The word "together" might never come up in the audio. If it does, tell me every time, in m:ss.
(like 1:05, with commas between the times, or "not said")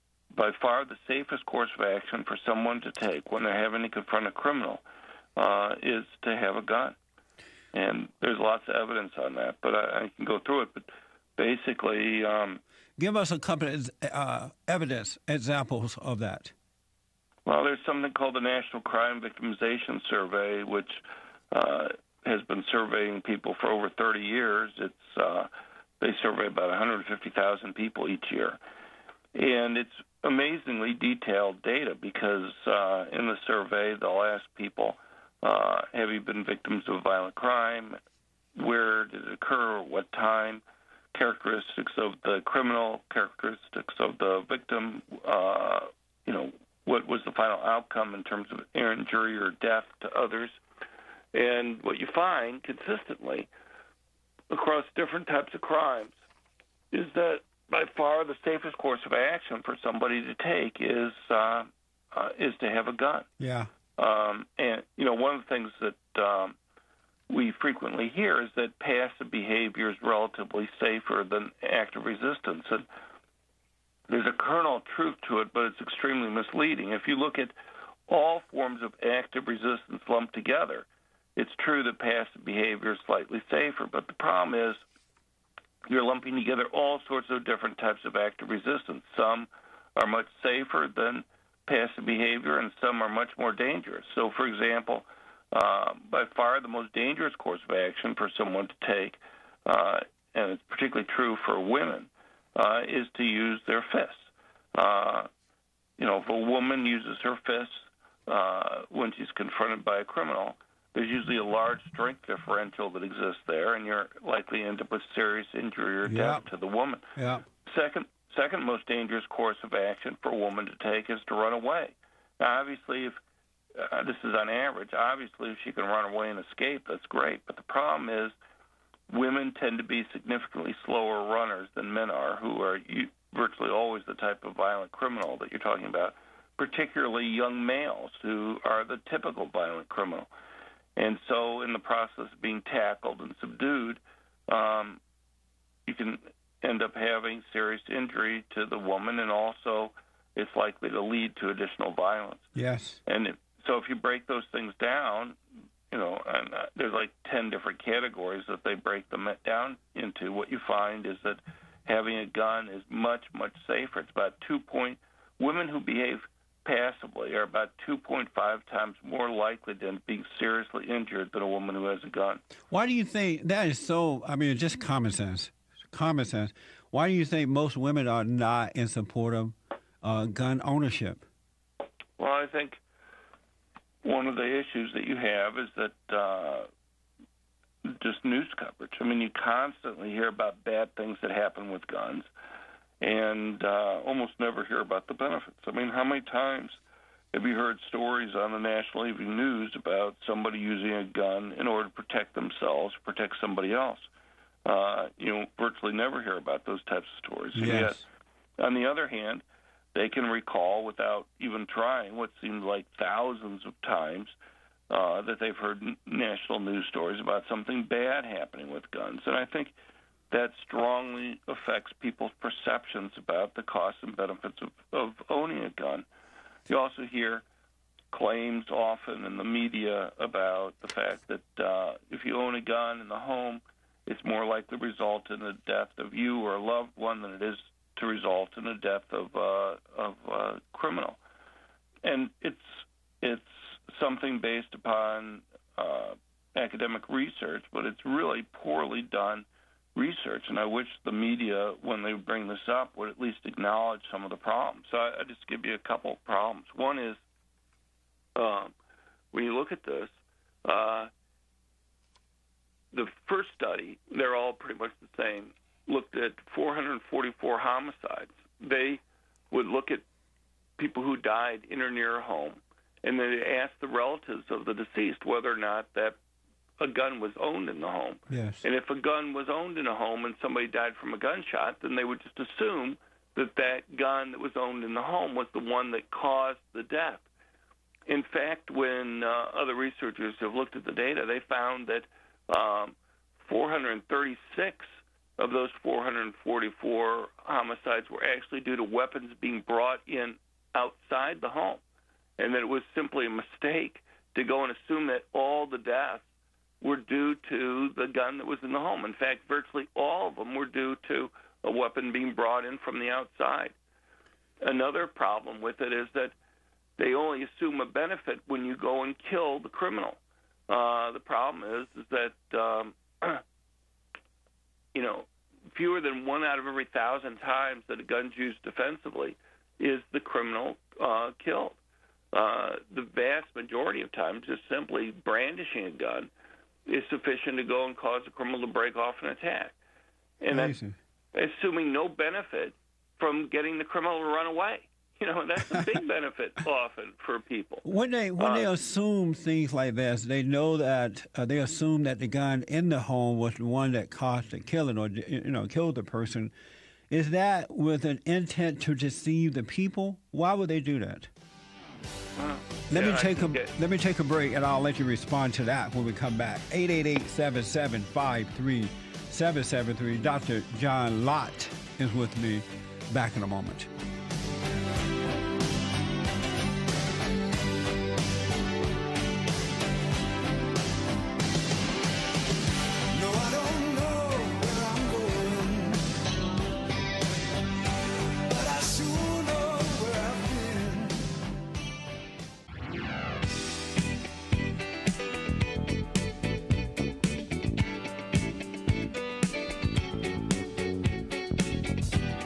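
1:20, 1:26.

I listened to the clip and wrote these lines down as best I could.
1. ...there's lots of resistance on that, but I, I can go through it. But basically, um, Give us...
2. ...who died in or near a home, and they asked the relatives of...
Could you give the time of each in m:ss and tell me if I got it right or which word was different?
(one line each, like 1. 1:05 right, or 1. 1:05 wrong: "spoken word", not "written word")
1. 0:08 wrong: "evidence", not "resistance"
2. 4:31 right.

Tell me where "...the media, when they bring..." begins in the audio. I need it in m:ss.
4:11.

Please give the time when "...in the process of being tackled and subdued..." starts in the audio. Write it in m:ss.
2:21.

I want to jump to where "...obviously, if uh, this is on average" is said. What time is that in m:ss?
2:02.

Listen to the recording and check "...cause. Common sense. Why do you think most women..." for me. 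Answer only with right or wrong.
wrong.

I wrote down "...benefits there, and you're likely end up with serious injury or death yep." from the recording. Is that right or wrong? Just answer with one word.
wrong.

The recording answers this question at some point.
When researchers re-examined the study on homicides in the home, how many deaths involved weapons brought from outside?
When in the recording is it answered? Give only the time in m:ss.
4:53.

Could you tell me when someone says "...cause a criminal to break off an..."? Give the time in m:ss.
5:37.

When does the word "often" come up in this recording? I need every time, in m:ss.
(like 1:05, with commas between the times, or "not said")
3:48, 5:46.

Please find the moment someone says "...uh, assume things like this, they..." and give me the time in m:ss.
5:48.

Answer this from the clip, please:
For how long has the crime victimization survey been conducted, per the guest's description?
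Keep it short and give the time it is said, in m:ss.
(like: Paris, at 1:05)
over 30 years, at 0:23.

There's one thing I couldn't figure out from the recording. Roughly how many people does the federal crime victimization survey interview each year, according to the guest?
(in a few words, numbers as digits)
150,000.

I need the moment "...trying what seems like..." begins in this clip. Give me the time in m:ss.
3:31.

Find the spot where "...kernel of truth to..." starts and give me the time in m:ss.
1:14.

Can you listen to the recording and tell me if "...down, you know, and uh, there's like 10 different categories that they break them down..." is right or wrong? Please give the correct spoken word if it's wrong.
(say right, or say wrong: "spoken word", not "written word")
right.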